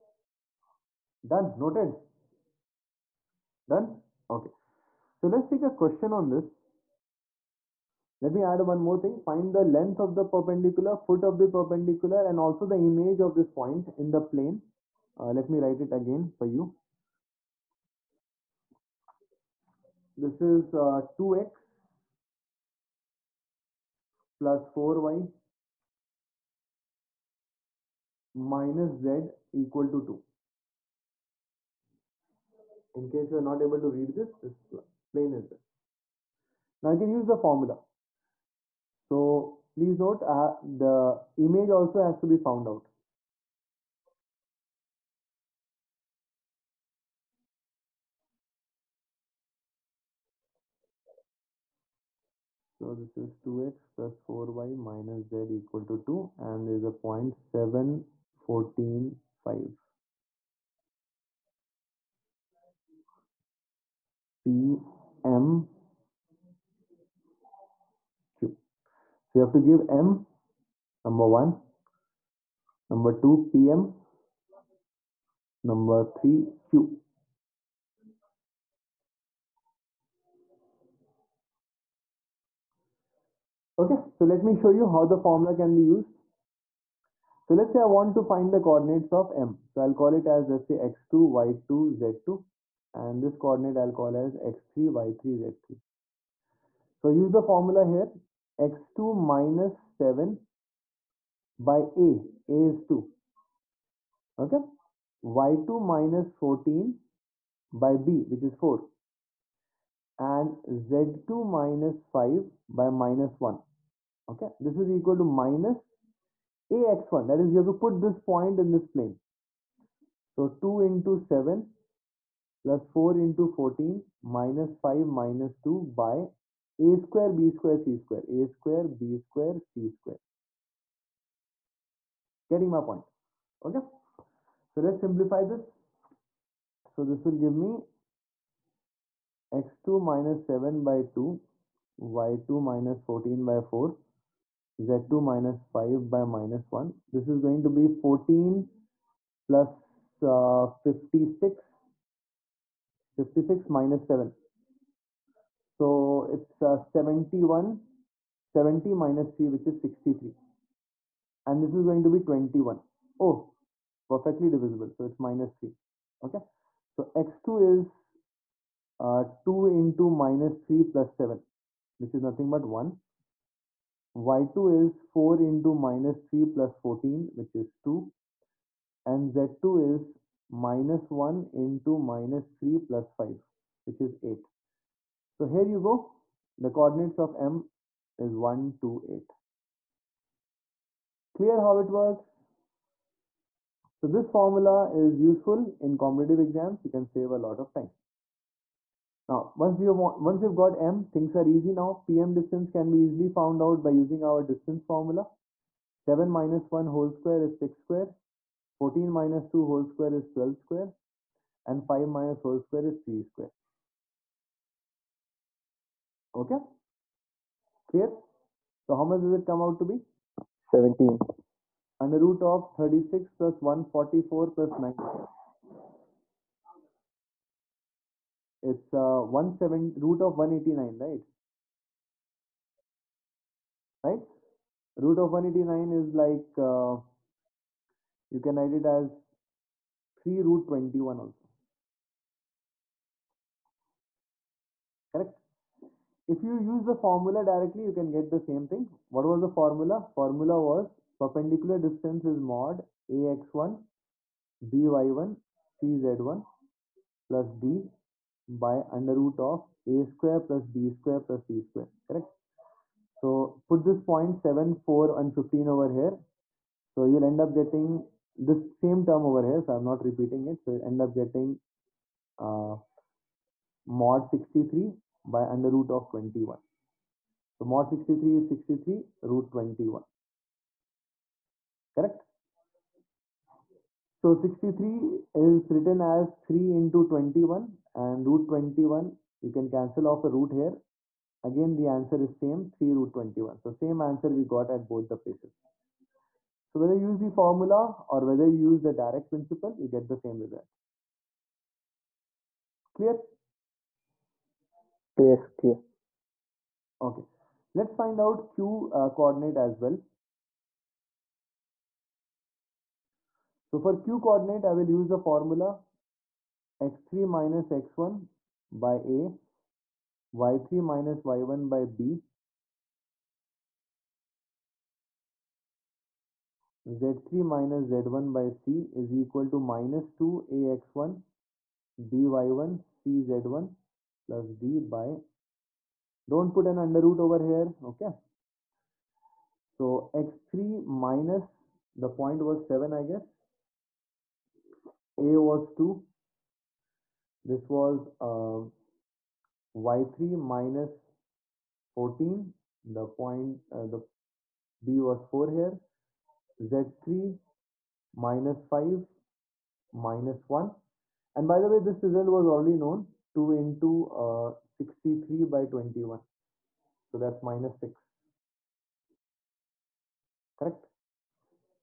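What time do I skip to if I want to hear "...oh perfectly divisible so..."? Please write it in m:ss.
2:43.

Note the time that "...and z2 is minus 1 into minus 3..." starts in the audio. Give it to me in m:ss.
2:59.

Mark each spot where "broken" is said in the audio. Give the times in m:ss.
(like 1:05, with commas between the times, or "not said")
not said.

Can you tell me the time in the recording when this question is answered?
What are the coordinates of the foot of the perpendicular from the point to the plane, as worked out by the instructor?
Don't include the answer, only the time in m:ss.
3:08.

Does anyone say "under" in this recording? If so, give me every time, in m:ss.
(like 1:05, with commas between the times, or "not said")
3:42, 4:18, 4:35, 5:36.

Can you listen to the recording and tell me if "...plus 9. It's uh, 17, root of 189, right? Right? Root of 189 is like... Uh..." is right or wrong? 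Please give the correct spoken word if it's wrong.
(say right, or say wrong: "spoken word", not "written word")
right.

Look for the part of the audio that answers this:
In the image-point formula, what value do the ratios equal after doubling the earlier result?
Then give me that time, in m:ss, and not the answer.
6:07.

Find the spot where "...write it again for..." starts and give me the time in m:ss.
0:15.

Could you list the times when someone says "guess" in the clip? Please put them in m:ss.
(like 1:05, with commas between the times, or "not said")
5:43.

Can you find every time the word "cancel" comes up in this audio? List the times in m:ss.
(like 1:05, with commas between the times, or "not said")
4:49.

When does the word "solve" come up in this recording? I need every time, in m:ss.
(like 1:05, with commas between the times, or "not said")
not said.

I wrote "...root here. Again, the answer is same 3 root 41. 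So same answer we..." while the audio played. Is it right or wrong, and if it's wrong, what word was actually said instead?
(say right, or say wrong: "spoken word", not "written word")
wrong: "21", not "41".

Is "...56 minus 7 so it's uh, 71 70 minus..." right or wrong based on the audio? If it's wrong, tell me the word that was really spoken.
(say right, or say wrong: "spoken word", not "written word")
right.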